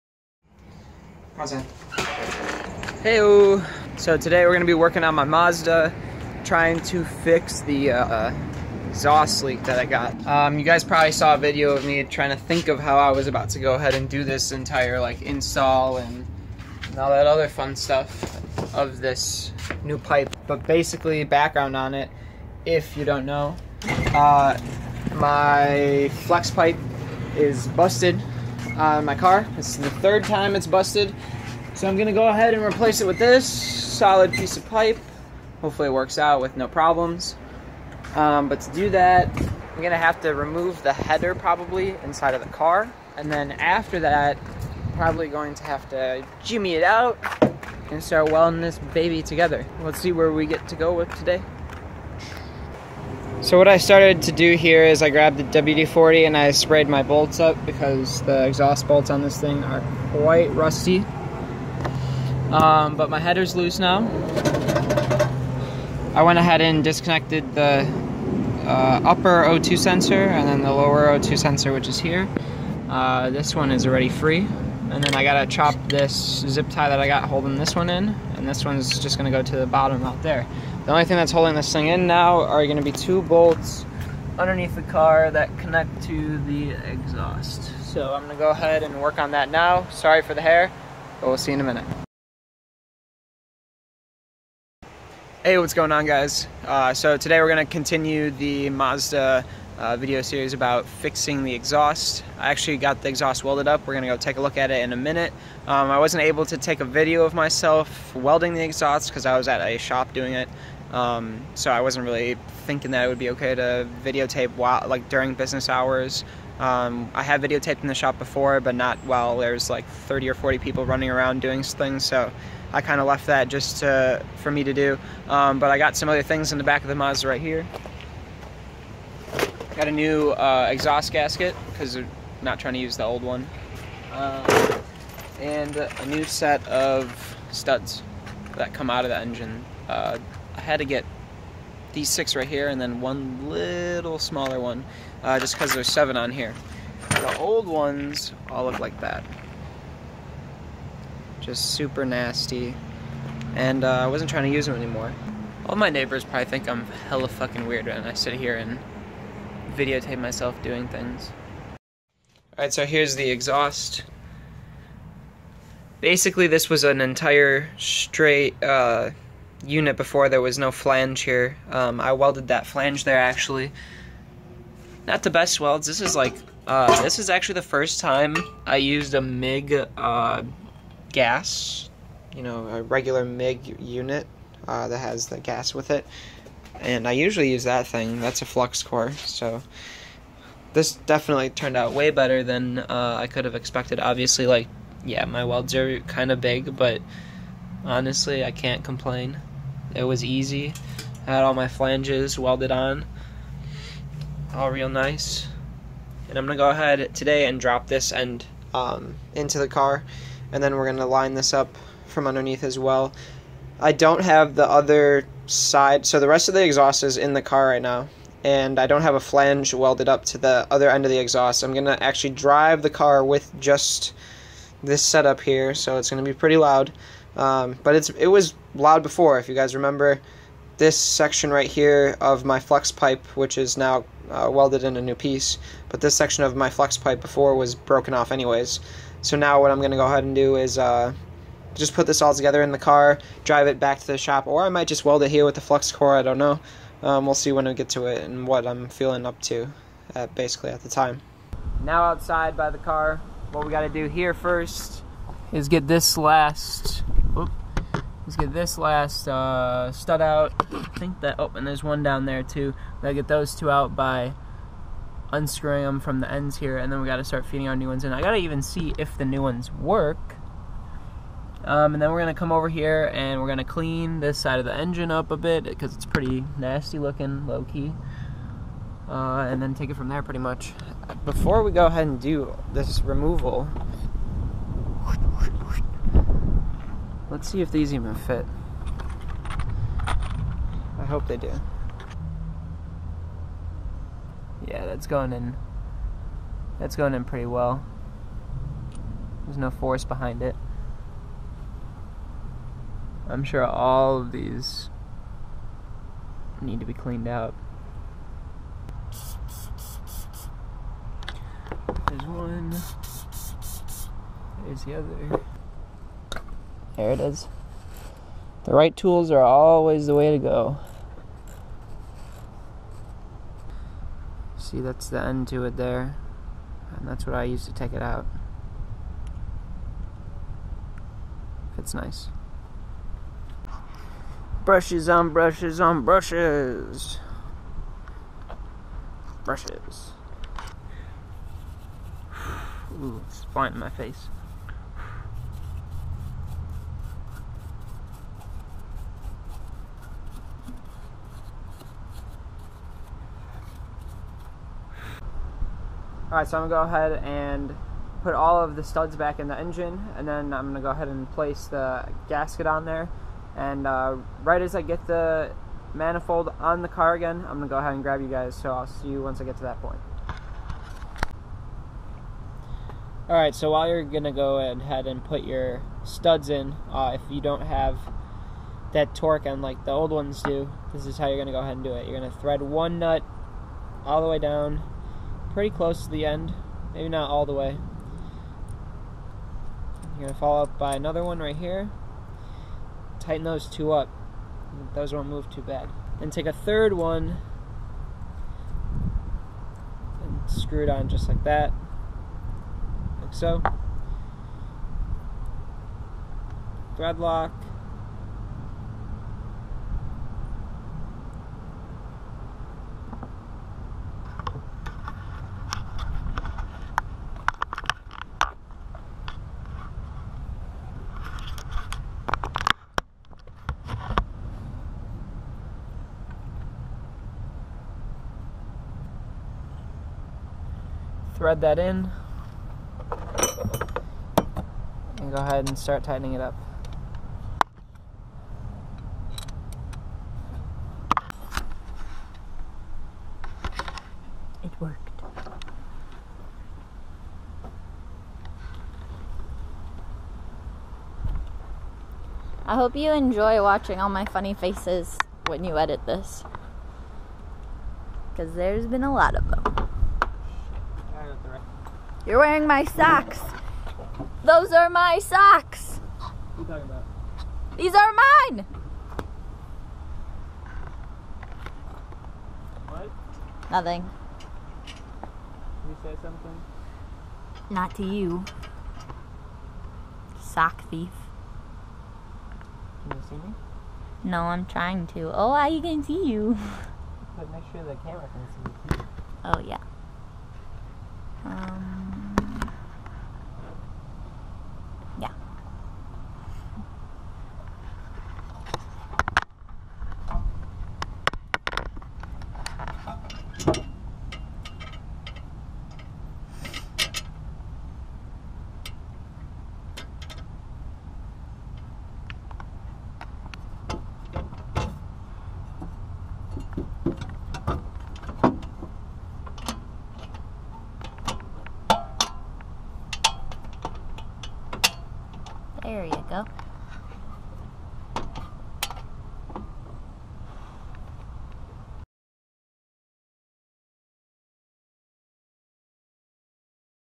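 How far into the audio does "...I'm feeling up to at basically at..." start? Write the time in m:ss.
4:08.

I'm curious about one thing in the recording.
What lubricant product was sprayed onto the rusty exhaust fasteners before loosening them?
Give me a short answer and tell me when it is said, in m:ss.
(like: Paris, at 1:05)
WD-40, at 0:55.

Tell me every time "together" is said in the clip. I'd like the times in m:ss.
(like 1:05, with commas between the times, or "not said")
0:49, 4:02.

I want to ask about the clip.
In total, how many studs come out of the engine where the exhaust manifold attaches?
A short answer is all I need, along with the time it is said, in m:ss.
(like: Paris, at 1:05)
7, at 2:25.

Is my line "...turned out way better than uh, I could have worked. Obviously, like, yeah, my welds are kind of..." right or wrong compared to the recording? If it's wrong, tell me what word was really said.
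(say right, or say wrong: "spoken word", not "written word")
wrong: "expected", not "worked".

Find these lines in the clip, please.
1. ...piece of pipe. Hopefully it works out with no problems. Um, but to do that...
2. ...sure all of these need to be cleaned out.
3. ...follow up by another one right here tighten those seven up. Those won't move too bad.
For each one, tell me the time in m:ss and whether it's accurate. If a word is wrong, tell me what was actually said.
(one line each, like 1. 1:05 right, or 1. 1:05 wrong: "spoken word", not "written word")
1. 0:34 right
2. 5:03 right
3. 6:30 wrong: "two", not "seven".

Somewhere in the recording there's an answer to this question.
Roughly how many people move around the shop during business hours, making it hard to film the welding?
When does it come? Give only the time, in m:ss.
1:59.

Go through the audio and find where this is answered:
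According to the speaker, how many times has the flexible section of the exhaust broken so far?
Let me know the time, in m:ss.
0:29.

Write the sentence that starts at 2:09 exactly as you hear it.
Got a new uh, exhaust gasket because they're not trying to use the old one.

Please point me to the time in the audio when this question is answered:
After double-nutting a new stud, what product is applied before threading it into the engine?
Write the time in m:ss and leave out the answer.
6:46.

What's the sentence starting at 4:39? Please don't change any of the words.
Uh, and then take it from there pretty much.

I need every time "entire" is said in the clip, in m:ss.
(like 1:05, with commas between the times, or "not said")
0:14, 2:47.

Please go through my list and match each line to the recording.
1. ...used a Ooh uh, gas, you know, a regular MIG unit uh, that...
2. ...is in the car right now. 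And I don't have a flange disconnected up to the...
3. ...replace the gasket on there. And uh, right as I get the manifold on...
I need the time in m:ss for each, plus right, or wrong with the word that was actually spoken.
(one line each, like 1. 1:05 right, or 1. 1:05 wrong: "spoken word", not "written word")
1. 2:58 wrong: "MIG", not "Ooh"
2. 3:37 wrong: "welded", not "disconnected"
3. 6:01 wrong: "place", not "replace".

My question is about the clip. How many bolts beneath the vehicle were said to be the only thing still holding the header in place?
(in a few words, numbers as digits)
2.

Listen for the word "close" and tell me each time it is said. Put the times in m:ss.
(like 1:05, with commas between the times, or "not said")
6:25.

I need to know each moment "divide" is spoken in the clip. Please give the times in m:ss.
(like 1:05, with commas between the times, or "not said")
not said.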